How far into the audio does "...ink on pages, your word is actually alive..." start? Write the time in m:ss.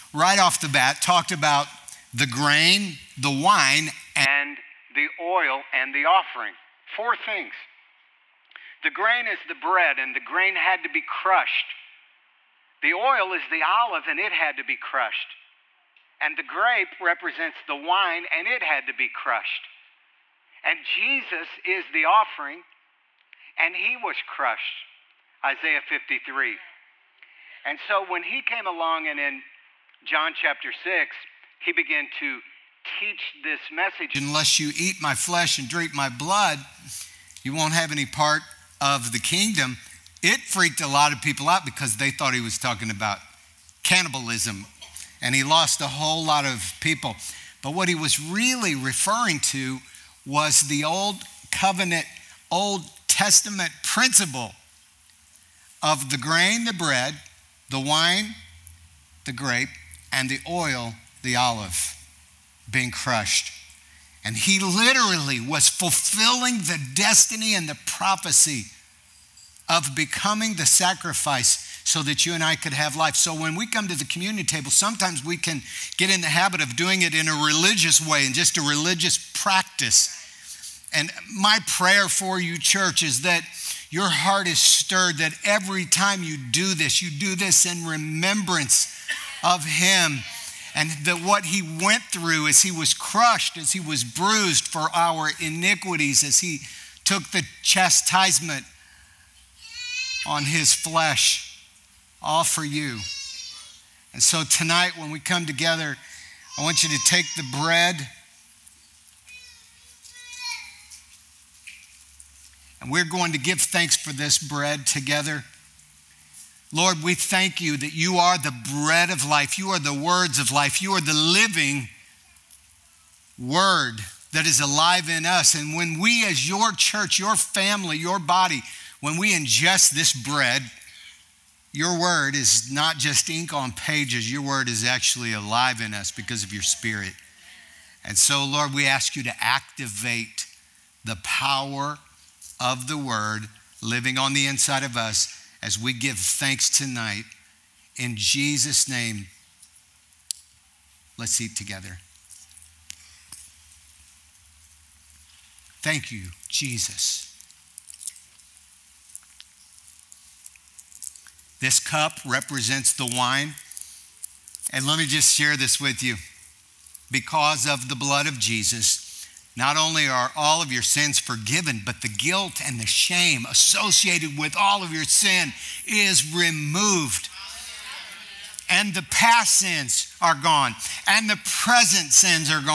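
2:13.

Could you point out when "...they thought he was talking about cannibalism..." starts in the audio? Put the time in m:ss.
0:41.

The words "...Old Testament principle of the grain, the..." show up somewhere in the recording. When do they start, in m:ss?
0:52.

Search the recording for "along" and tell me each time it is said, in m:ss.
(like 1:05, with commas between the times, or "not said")
0:28.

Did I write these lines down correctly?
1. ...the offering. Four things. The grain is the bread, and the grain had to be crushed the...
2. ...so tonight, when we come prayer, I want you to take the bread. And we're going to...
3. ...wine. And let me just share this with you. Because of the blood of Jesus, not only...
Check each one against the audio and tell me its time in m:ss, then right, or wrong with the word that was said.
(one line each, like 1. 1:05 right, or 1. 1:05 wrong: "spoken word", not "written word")
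1. 0:05 right
2. 1:44 wrong: "together", not "prayer"
3. 2:43 right.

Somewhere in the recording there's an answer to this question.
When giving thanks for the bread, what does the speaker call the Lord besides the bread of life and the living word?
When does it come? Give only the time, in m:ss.
1:59.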